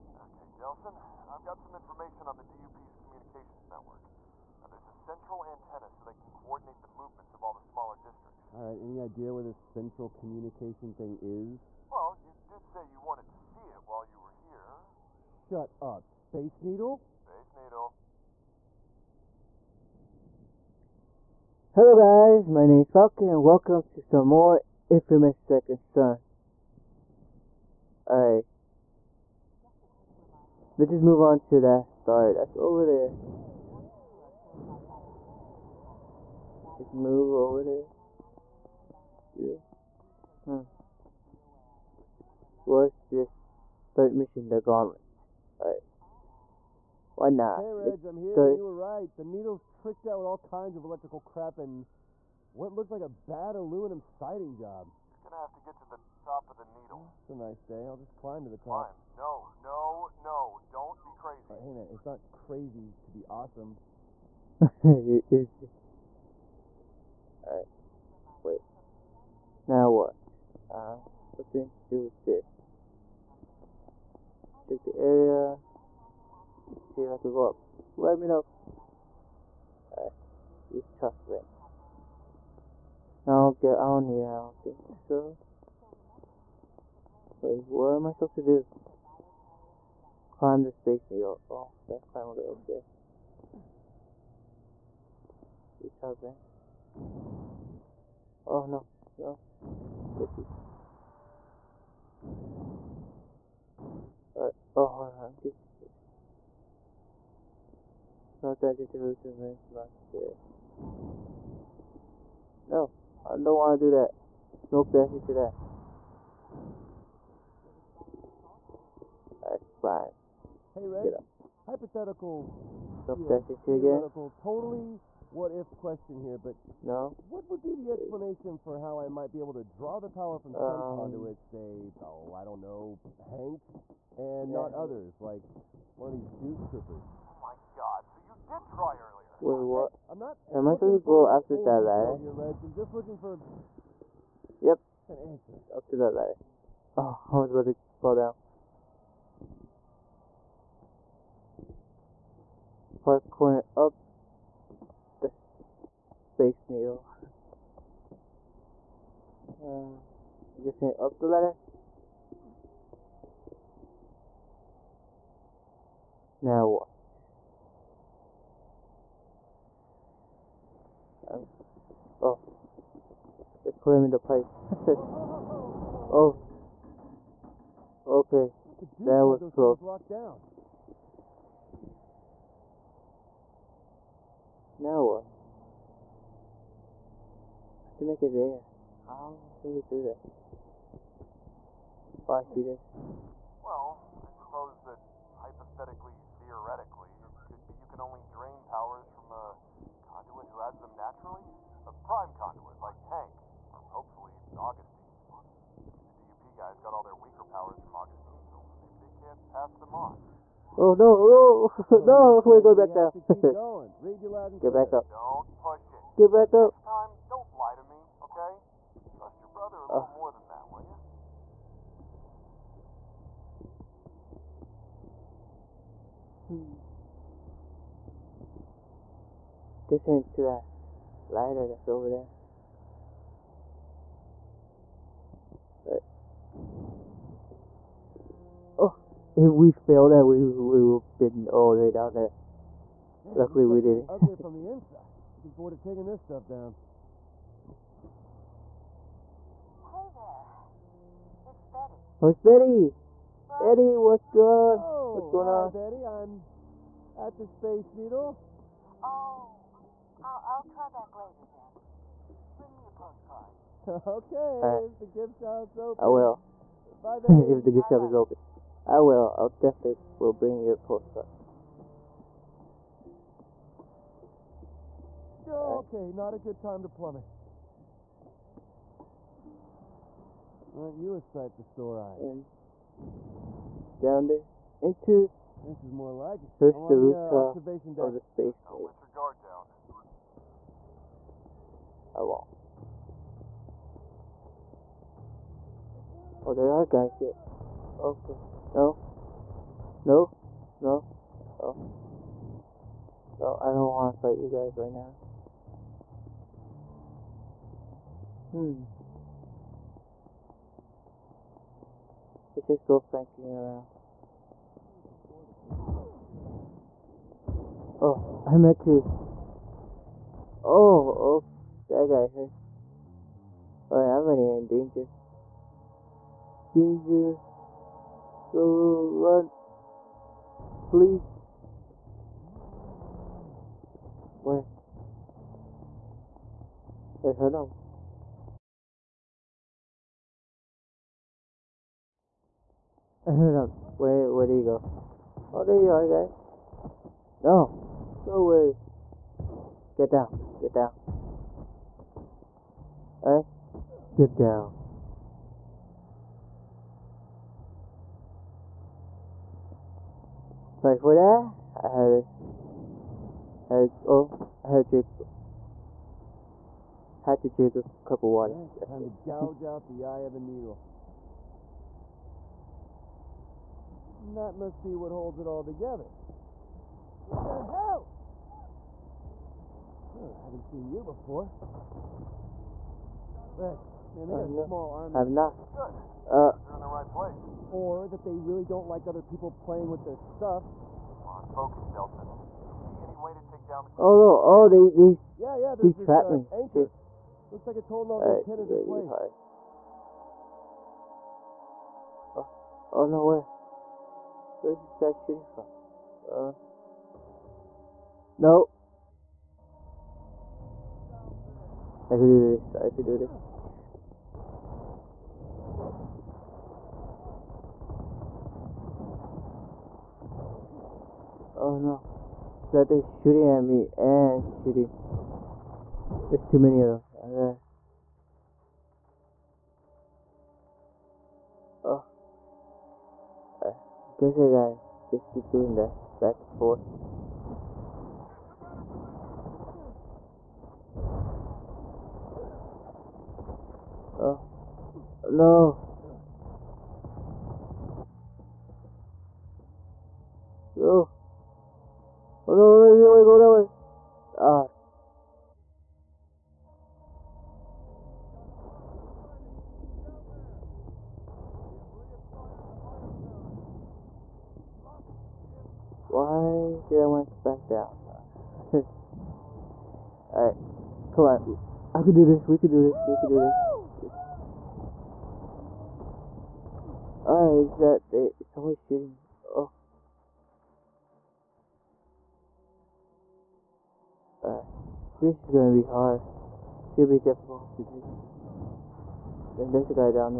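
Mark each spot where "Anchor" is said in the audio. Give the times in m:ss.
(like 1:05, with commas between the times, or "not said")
6:36.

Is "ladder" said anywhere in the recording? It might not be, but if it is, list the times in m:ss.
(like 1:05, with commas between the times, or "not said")
2:21, 2:26, 2:41.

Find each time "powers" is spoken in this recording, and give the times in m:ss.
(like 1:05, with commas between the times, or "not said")
2:10, 3:18, 3:27.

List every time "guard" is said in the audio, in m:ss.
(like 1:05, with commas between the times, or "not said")
4:49.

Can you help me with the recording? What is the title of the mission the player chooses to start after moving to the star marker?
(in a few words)
The Gauntlet.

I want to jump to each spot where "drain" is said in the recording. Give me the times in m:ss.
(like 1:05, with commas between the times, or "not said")
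3:18.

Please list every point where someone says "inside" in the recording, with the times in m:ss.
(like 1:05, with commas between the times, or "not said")
4:04.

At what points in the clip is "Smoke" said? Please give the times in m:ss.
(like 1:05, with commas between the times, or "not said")
1:54, 2:03.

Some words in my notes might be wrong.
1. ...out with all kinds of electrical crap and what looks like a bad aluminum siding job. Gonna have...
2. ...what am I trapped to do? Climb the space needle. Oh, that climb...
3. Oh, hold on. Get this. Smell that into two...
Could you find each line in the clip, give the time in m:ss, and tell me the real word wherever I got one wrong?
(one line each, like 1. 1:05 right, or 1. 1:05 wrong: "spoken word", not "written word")
1. 0:50 right
2. 1:27 wrong: "supposed", not "trapped"
3. 1:44 right.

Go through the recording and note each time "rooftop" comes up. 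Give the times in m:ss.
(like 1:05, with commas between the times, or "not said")
1:20, 4:46.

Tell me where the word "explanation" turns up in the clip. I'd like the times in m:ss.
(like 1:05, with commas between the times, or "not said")
2:07.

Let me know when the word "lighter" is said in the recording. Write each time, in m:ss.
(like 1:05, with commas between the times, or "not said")
3:51.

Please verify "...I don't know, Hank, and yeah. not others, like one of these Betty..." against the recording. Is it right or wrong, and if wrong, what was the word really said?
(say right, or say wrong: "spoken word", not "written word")
wrong: "Duke", not "Betty".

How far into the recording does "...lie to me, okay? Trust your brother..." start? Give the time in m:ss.
3:37.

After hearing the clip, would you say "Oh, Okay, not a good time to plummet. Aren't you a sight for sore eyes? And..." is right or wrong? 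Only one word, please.
right.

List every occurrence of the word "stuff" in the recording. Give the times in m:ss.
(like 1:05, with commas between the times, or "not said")
4:06, 6:30.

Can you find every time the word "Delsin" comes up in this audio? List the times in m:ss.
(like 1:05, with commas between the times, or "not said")
0:00, 6:31.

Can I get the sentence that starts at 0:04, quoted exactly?
Now, there's a central antenna so they can coordinate the movements of all the smaller districts.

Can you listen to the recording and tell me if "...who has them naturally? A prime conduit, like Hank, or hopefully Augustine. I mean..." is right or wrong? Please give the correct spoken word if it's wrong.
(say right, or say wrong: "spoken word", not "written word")
right.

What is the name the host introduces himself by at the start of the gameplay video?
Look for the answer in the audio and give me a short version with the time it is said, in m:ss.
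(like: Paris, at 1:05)
Falcon, at 0:22.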